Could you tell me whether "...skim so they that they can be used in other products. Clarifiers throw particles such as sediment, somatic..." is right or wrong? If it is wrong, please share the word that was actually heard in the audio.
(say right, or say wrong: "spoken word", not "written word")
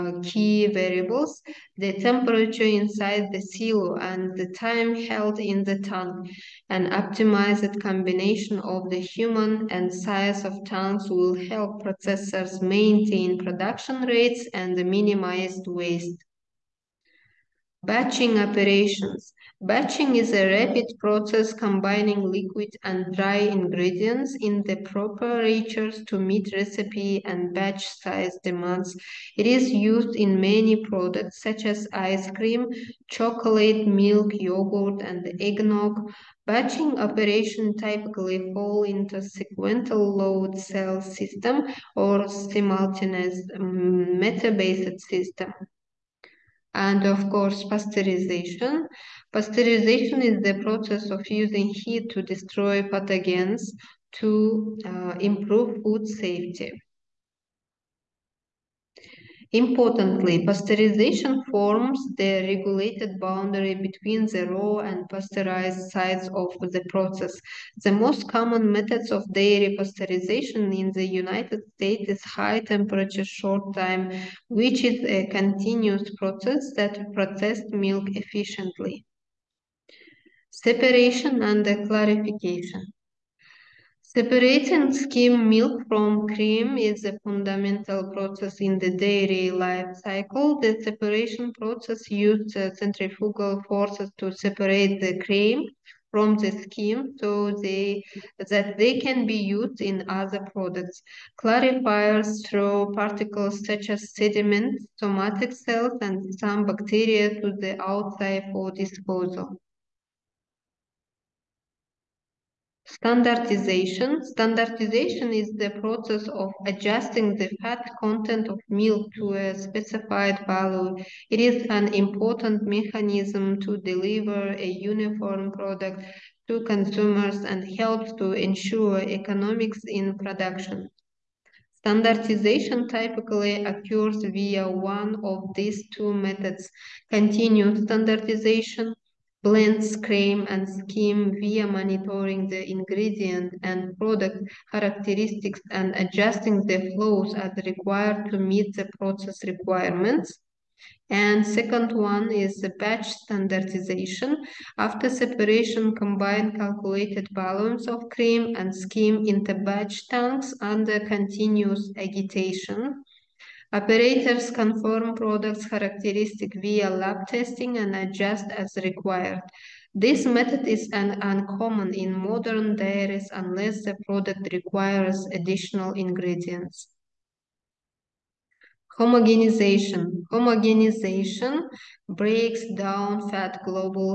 right.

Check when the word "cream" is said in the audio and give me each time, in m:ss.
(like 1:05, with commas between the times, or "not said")
0:32, 1:26, 1:35, 2:19, 2:38.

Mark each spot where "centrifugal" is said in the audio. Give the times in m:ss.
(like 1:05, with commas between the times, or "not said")
1:32.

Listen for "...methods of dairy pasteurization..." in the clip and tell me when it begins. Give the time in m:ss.
1:08.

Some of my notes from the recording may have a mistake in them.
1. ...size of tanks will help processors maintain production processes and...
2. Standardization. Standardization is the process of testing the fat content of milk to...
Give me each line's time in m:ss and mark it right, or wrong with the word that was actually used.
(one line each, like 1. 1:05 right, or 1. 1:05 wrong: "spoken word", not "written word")
1. 0:09 wrong: "rates", not "processes"
2. 1:52 wrong: "adjusting", not "testing".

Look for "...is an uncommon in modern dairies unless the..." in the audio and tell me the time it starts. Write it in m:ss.
2:50.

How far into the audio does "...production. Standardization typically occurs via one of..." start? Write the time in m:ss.
2:10.